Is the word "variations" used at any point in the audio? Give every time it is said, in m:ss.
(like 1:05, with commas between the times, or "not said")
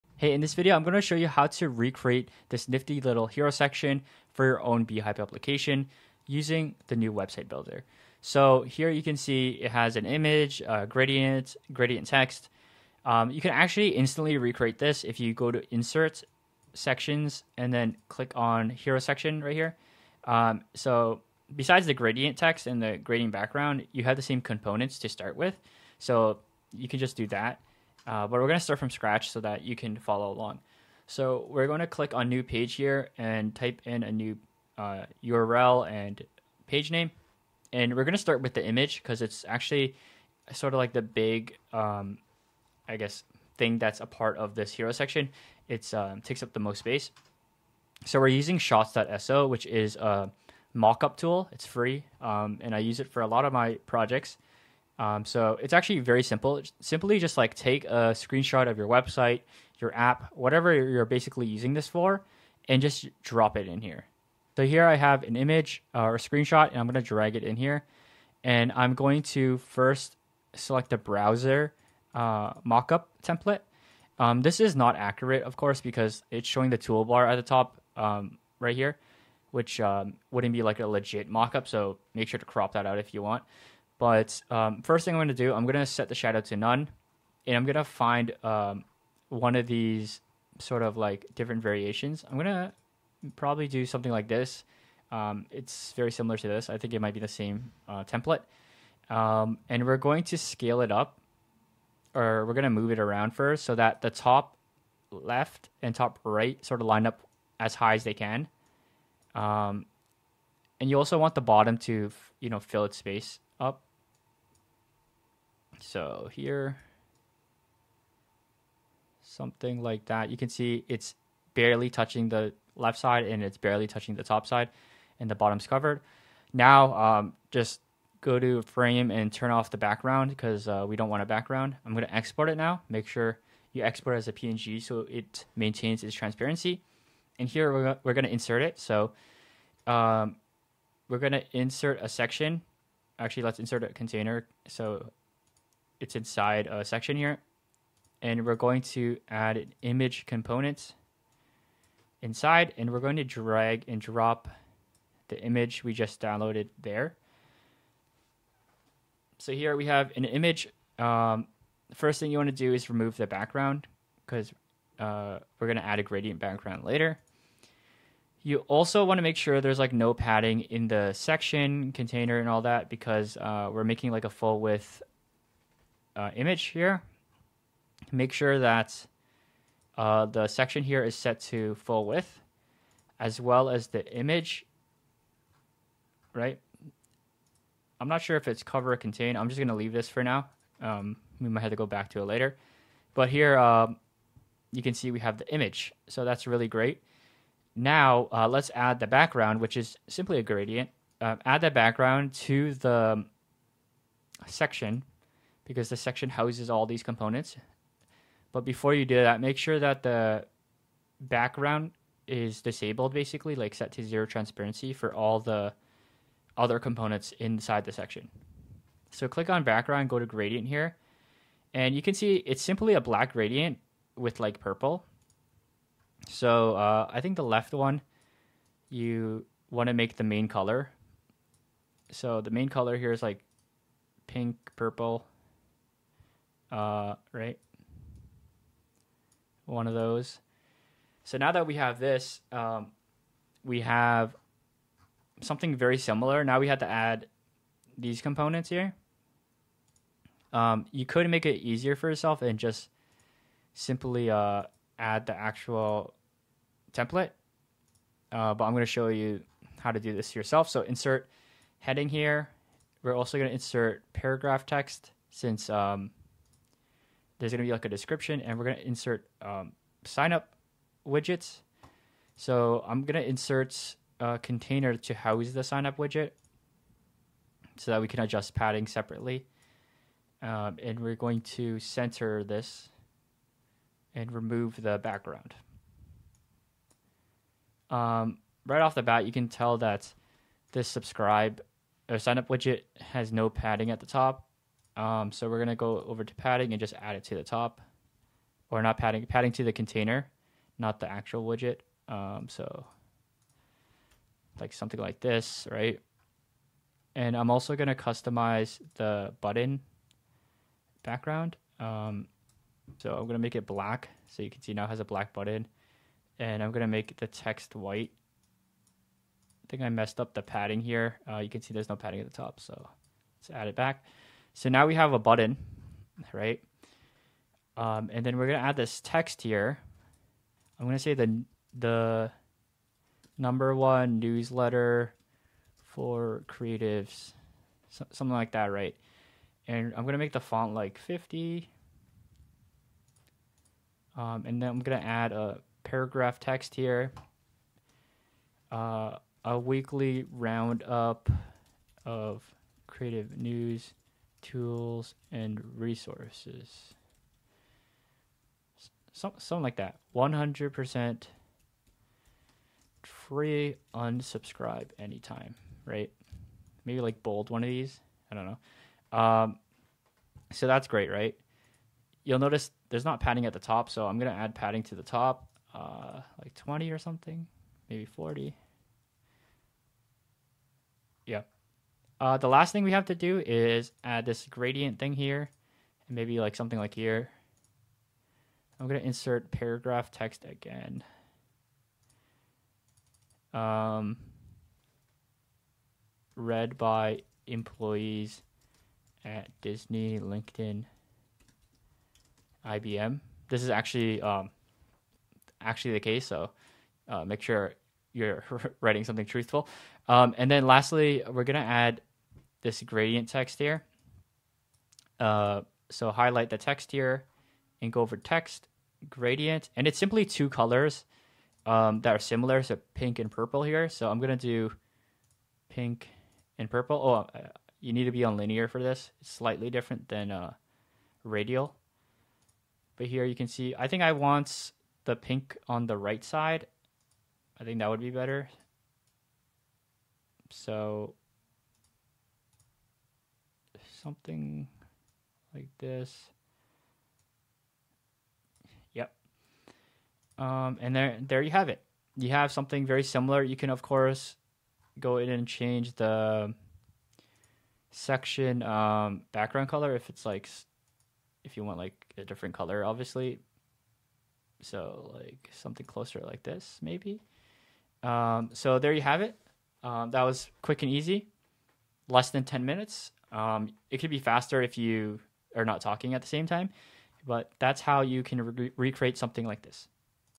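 1:31.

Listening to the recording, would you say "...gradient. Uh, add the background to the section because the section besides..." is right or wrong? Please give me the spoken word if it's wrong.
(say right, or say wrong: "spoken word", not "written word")
wrong: "houses", not "besides".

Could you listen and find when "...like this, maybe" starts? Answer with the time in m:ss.
7:46.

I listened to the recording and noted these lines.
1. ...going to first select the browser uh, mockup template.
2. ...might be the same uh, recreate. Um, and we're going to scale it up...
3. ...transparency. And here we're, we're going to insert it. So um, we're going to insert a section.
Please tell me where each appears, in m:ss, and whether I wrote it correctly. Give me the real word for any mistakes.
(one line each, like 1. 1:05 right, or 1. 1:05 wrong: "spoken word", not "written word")
1. 1:08 right
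2. 1:36 wrong: "template", not "recreate"
3. 2:16 right.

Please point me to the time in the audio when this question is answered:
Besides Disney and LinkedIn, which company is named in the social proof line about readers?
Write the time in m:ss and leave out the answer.
6:42.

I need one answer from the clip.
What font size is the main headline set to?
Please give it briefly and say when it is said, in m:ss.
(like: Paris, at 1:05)
50, at 5:40.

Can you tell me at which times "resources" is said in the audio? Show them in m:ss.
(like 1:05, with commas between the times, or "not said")
5:55.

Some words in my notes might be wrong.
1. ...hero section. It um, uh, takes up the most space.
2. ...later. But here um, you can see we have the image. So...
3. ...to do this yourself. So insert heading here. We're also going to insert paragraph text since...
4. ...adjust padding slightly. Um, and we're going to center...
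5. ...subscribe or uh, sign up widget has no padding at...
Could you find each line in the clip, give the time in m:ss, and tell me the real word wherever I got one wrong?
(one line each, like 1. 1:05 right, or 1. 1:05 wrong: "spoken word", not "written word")
1. 0:44 right
2. 3:12 right
3. 4:19 right
4. 4:38 wrong: "separately", not "slightly"
5. 4:50 right.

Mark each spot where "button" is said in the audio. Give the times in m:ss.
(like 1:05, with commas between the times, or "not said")
5:09, 5:15, 5:25.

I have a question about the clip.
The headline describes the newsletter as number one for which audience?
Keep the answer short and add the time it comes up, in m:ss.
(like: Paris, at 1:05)
creatives, at 5:36.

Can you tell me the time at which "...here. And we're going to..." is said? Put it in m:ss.
2:27.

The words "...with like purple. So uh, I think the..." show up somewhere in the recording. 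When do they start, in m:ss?
3:44.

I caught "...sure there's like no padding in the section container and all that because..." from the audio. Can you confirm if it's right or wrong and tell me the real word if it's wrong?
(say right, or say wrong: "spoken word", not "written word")
right.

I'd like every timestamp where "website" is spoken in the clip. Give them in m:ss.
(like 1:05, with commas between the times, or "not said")
0:07, 0:58.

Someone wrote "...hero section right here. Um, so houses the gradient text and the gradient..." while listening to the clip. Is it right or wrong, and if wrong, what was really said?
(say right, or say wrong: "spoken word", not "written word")
wrong: "besides", not "houses".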